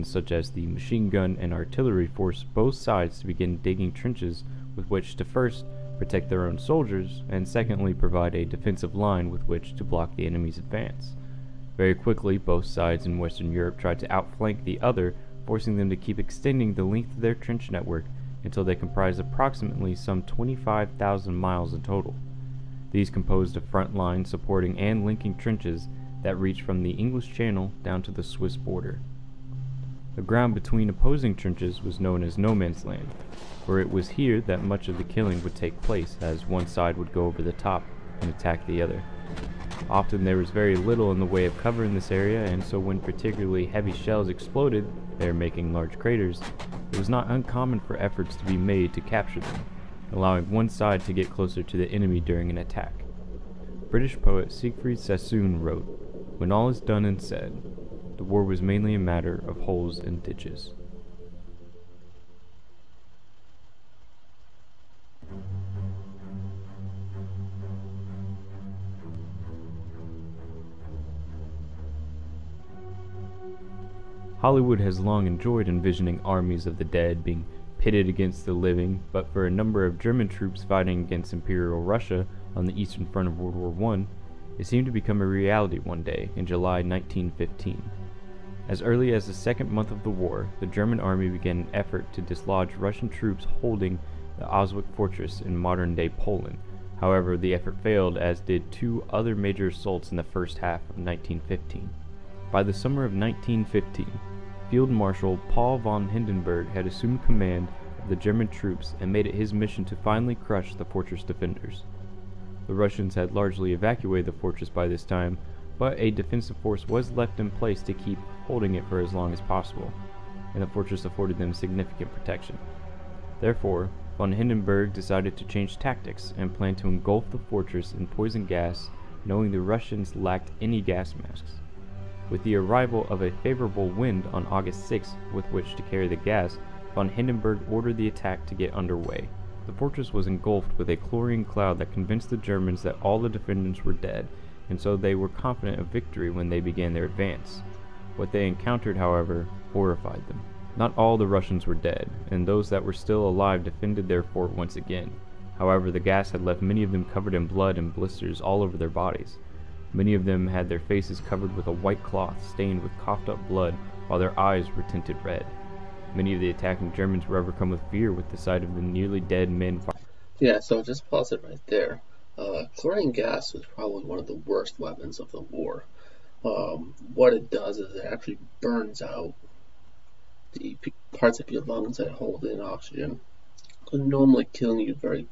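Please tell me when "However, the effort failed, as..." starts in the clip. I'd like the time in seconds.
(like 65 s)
97 s.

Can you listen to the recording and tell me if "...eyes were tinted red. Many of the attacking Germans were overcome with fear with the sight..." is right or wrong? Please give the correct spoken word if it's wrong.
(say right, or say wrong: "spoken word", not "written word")
right.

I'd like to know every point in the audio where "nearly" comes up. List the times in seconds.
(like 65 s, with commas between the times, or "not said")
168 s.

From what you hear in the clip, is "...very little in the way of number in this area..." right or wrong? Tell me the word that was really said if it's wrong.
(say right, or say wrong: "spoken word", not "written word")
wrong: "cover", not "number".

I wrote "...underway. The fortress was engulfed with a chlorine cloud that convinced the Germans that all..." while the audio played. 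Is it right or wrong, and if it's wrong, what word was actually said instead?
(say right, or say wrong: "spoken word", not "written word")
right.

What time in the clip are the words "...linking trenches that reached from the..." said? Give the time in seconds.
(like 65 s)
25 s.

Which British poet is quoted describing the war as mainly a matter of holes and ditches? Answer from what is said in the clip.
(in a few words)
Siegfried Sassoon.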